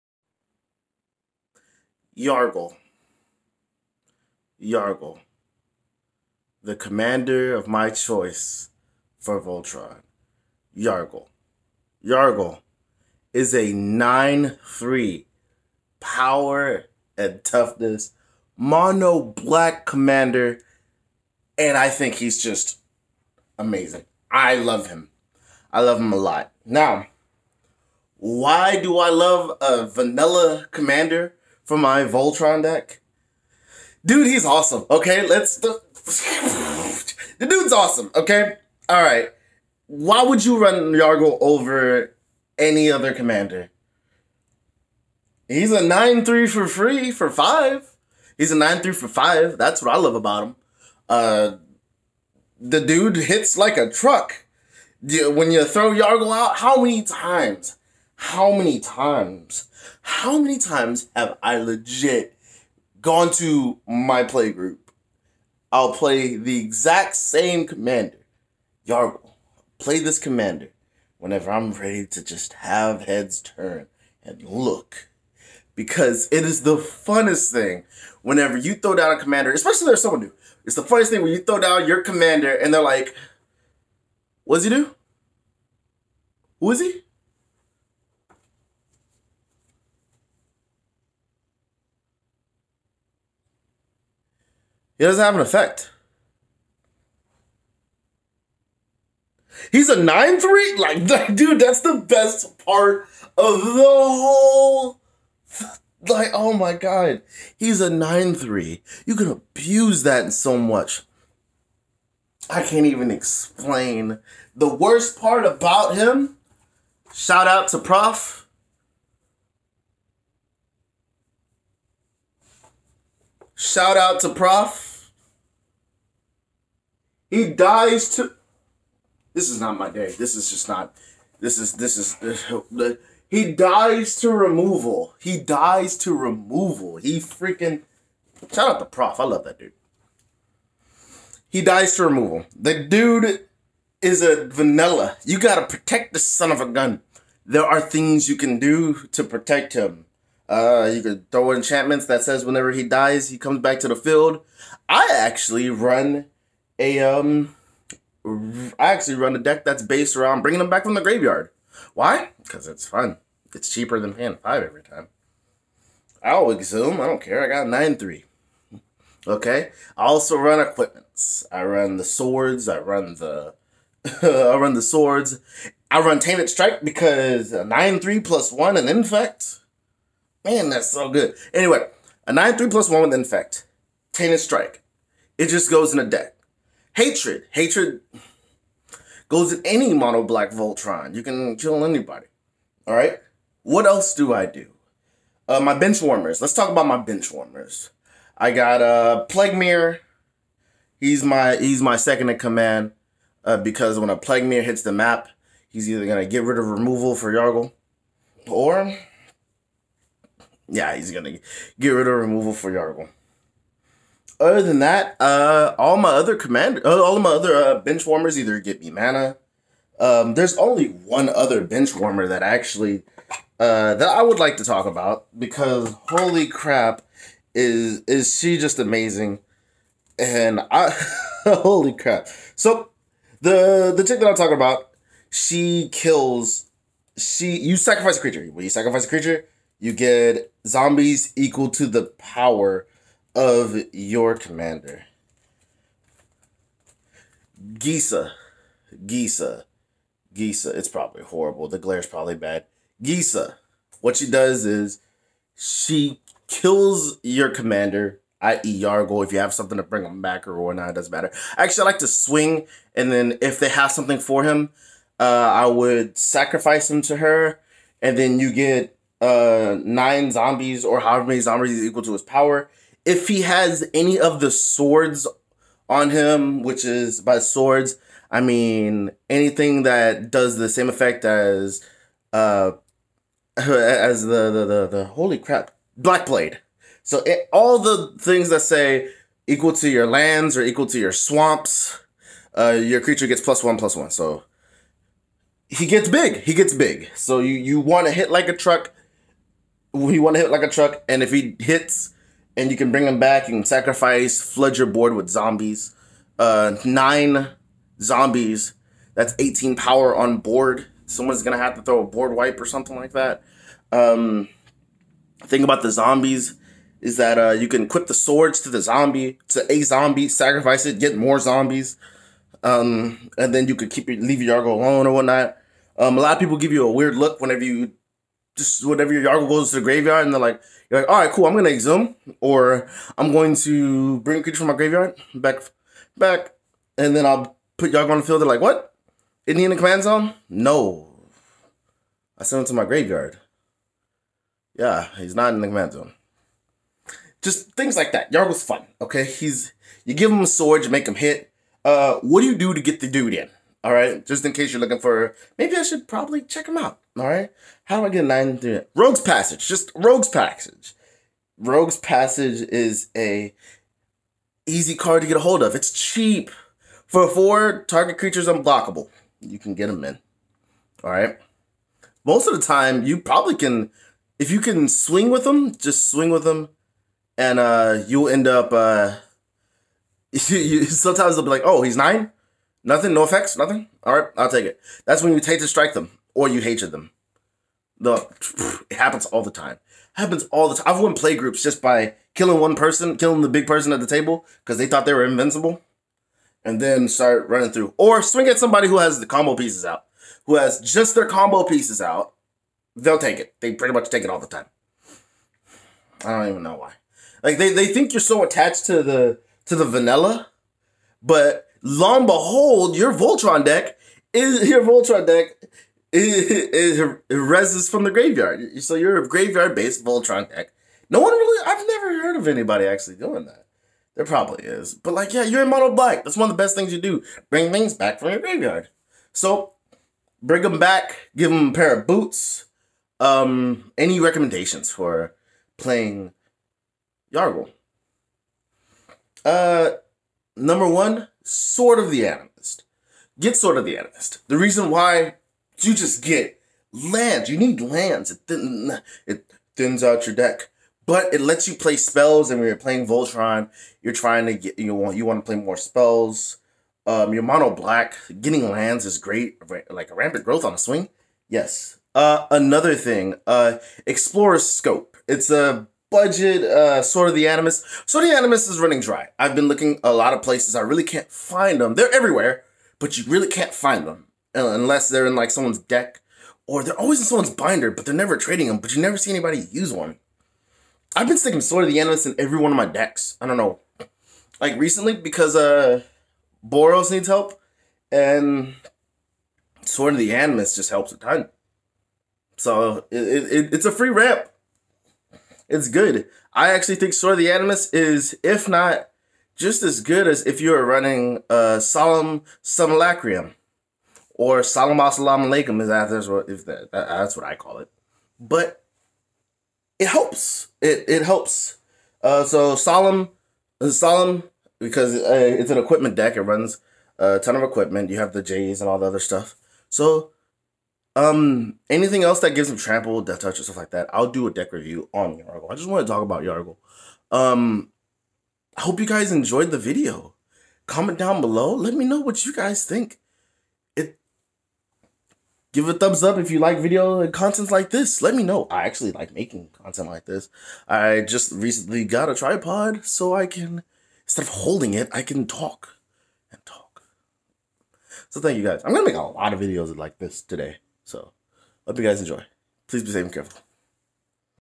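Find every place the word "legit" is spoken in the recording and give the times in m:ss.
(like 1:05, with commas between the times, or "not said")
1:01.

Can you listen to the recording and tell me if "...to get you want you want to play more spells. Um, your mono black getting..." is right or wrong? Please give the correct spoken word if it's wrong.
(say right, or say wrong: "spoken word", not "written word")
right.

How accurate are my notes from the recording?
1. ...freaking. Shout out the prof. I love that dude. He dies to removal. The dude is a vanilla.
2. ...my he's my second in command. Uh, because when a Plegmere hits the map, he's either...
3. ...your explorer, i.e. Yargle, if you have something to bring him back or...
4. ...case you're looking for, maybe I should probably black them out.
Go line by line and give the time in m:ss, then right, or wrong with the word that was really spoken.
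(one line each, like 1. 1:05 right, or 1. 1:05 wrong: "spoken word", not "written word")
1. 2:17 right
2. 3:21 right
3. 4:17 wrong: "commander", not "explorer"
4. 5:54 wrong: "check", not "black".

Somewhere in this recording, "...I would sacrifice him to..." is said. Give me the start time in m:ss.
4:25.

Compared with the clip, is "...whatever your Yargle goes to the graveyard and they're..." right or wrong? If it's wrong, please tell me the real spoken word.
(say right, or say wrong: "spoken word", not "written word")
right.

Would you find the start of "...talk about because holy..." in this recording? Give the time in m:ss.
3:44.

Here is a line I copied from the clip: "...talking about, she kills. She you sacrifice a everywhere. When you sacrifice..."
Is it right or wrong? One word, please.
wrong.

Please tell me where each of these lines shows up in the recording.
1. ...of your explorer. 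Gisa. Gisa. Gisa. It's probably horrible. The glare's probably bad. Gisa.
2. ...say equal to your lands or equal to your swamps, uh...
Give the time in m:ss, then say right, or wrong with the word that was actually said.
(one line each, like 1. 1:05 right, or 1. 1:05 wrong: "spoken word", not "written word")
1. 4:03 wrong: "commander", not "explorer"
2. 4:48 right.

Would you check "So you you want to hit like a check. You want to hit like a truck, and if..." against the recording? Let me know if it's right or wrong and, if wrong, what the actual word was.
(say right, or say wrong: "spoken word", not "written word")
wrong: "truck", not "check".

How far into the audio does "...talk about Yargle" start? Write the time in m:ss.
8:46.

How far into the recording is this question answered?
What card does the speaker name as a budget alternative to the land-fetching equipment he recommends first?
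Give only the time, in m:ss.
7:44.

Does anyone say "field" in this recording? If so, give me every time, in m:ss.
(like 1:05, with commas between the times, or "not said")
2:33, 5:38.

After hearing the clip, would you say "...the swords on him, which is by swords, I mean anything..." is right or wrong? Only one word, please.
right.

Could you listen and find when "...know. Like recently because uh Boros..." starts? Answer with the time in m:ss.
8:03.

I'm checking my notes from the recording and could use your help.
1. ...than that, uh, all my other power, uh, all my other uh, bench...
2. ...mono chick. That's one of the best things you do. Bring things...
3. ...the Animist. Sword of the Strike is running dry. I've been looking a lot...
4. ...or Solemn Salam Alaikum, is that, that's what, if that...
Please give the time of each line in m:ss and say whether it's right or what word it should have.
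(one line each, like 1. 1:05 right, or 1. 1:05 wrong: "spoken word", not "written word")
1. 3:34 wrong: "commander", not "power"
2. 7:05 wrong: "black", not "chick"
3. 7:47 wrong: "Animist", not "Strike"
4. 8:24 right.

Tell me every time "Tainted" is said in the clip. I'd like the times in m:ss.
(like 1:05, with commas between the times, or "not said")
2:56, 3:04.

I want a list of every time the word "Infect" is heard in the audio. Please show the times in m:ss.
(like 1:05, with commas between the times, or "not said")
2:58, 3:03.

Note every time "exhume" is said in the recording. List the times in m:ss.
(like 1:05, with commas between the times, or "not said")
2:46, 5:31.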